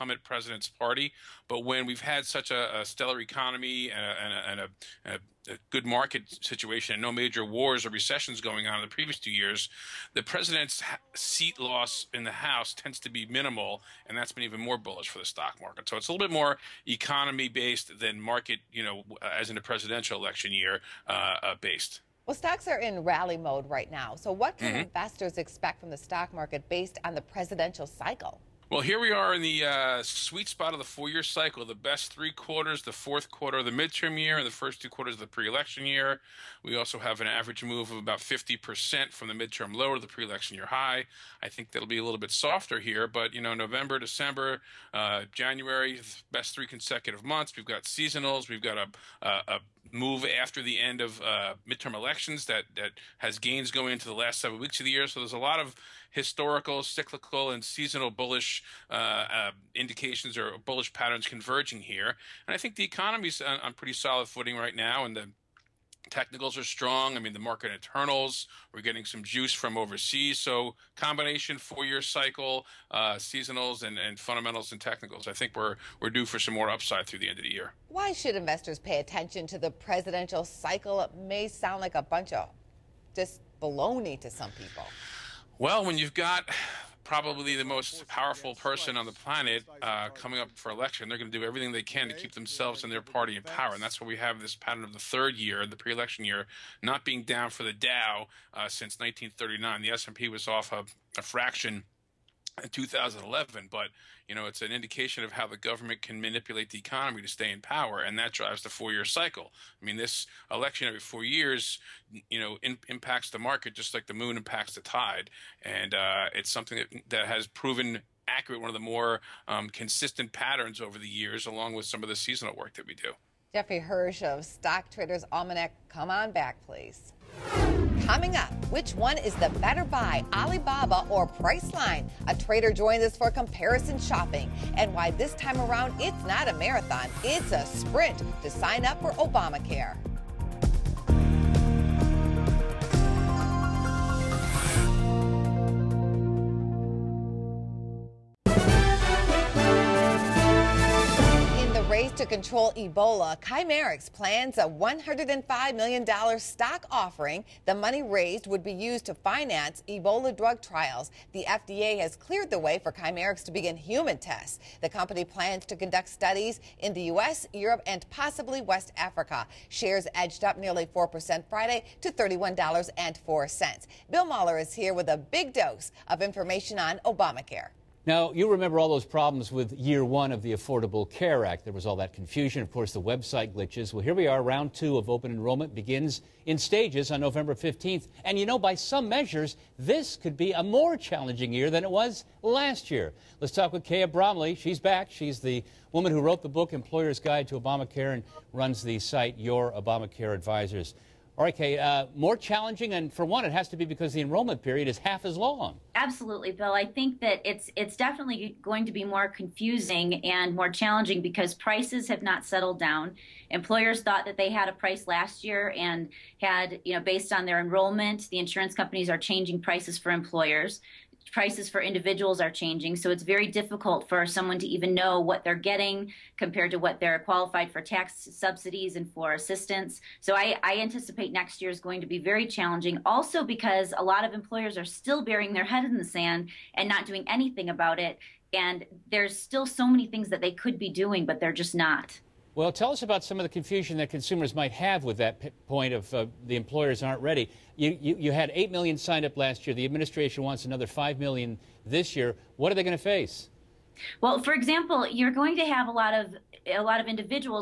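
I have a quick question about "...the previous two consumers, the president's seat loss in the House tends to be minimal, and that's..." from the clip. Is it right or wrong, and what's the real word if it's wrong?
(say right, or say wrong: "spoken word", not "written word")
wrong: "years", not "consumers".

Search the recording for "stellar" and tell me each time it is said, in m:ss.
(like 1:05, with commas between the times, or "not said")
0:02.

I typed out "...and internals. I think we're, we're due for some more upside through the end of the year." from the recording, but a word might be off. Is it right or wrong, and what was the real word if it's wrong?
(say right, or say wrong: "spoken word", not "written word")
wrong: "technicals", not "internals".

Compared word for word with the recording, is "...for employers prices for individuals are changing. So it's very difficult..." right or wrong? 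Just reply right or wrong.
right.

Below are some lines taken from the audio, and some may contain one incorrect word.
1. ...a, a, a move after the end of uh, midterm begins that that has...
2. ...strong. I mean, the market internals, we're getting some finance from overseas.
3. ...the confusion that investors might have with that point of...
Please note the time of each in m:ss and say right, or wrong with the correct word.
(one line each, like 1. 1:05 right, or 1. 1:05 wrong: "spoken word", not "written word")
1. 0:48 wrong: "elections", not "begins"
2. 1:06 wrong: "juice", not "finance"
3. 4:03 wrong: "consumers", not "investors".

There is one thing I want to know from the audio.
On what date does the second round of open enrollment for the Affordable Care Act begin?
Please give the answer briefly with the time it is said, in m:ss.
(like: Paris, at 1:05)
November 15th, at 3:07.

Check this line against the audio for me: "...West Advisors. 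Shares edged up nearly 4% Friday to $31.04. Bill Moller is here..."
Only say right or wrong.
wrong.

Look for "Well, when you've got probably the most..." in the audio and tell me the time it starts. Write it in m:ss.
1:25.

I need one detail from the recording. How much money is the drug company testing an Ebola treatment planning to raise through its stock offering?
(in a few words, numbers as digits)
$105 million.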